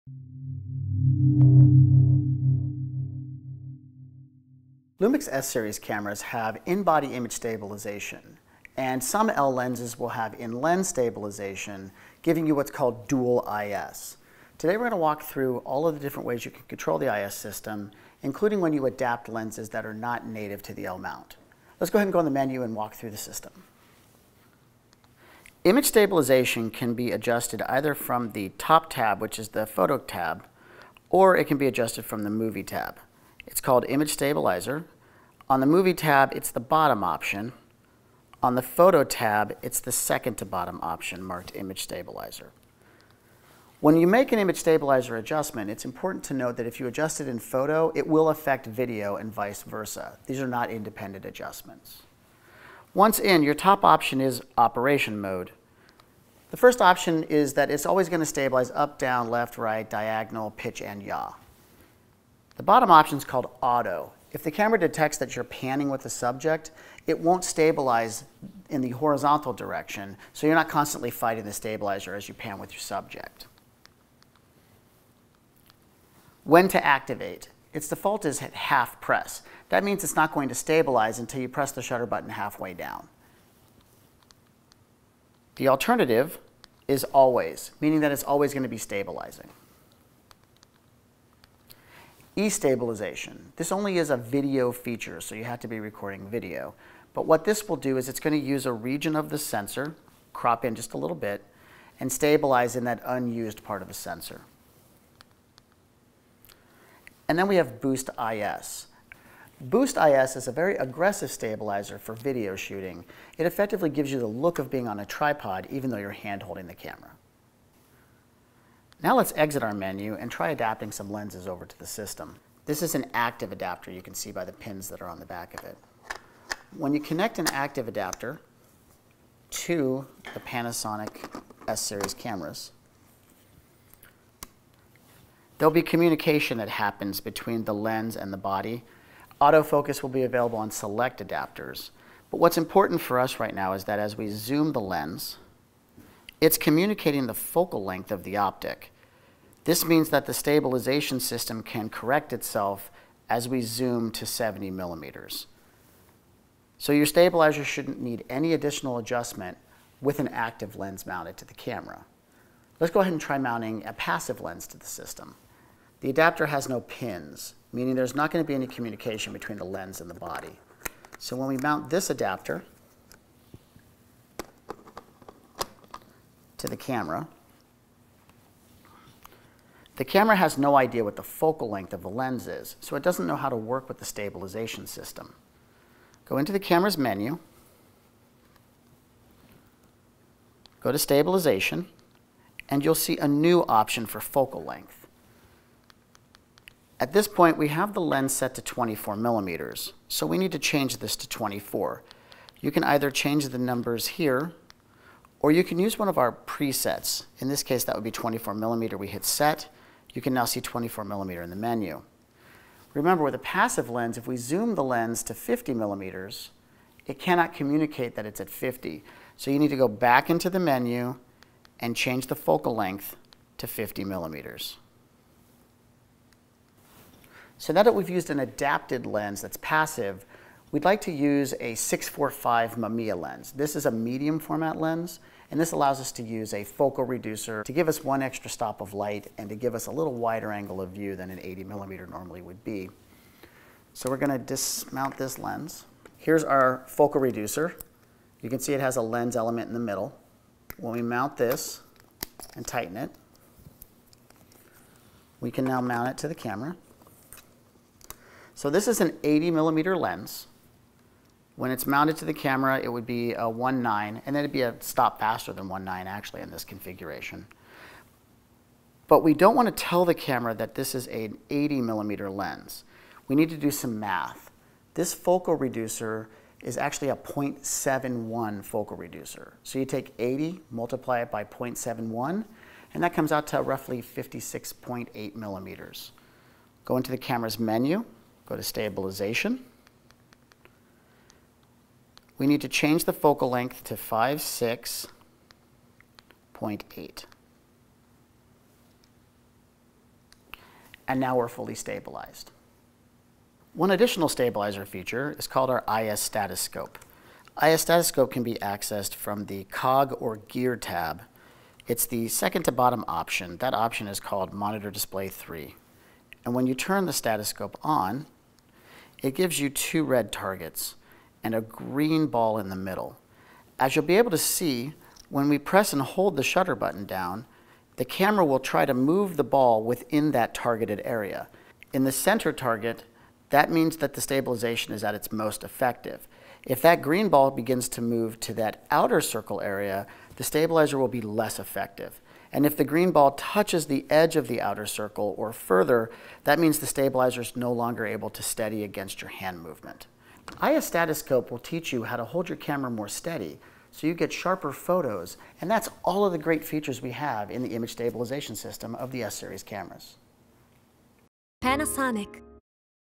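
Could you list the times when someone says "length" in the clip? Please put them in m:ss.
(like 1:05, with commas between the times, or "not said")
2:27, 3:01, 3:14, 3:42, 4:53.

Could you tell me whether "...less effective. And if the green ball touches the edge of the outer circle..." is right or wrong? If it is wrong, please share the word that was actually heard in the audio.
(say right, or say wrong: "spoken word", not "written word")
right.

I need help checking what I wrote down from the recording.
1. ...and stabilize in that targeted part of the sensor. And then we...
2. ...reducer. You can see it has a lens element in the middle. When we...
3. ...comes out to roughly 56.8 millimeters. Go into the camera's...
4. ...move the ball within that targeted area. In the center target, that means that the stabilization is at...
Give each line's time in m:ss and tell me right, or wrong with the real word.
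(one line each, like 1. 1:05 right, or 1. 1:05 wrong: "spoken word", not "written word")
1. 1:41 wrong: "unused", not "targeted"
2. 4:07 right
3. 4:43 right
4. 5:28 right.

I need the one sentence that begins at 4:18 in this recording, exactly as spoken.
So this is an 80 millimeter lens.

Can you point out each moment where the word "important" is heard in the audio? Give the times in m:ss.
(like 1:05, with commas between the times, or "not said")
0:45, 2:22.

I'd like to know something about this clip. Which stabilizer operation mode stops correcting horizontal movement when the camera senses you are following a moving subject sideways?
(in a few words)
Auto.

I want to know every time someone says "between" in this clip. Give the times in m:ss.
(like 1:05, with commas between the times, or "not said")
2:17, 2:49.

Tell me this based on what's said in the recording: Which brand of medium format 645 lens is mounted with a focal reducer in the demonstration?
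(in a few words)
Mamiya.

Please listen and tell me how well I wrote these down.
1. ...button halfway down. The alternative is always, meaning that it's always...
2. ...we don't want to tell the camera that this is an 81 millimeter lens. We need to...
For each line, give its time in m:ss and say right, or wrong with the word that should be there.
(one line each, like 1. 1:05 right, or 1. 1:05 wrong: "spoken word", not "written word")
1. 1:22 right
2. 4:29 wrong: "80", not "81".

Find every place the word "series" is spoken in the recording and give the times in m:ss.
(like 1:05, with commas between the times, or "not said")
0:05, 2:11, 5:59.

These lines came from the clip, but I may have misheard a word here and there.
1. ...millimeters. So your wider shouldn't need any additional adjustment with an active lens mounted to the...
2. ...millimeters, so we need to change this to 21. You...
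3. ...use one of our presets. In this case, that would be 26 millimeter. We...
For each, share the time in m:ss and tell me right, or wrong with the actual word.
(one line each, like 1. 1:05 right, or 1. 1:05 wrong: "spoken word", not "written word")
1. 2:34 wrong: "stabilizer", not "wider"
2. 3:19 wrong: "24", not "21"
3. 3:25 wrong: "24", not "26".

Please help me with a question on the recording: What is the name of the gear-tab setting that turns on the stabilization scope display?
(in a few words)
Monitor Display 3.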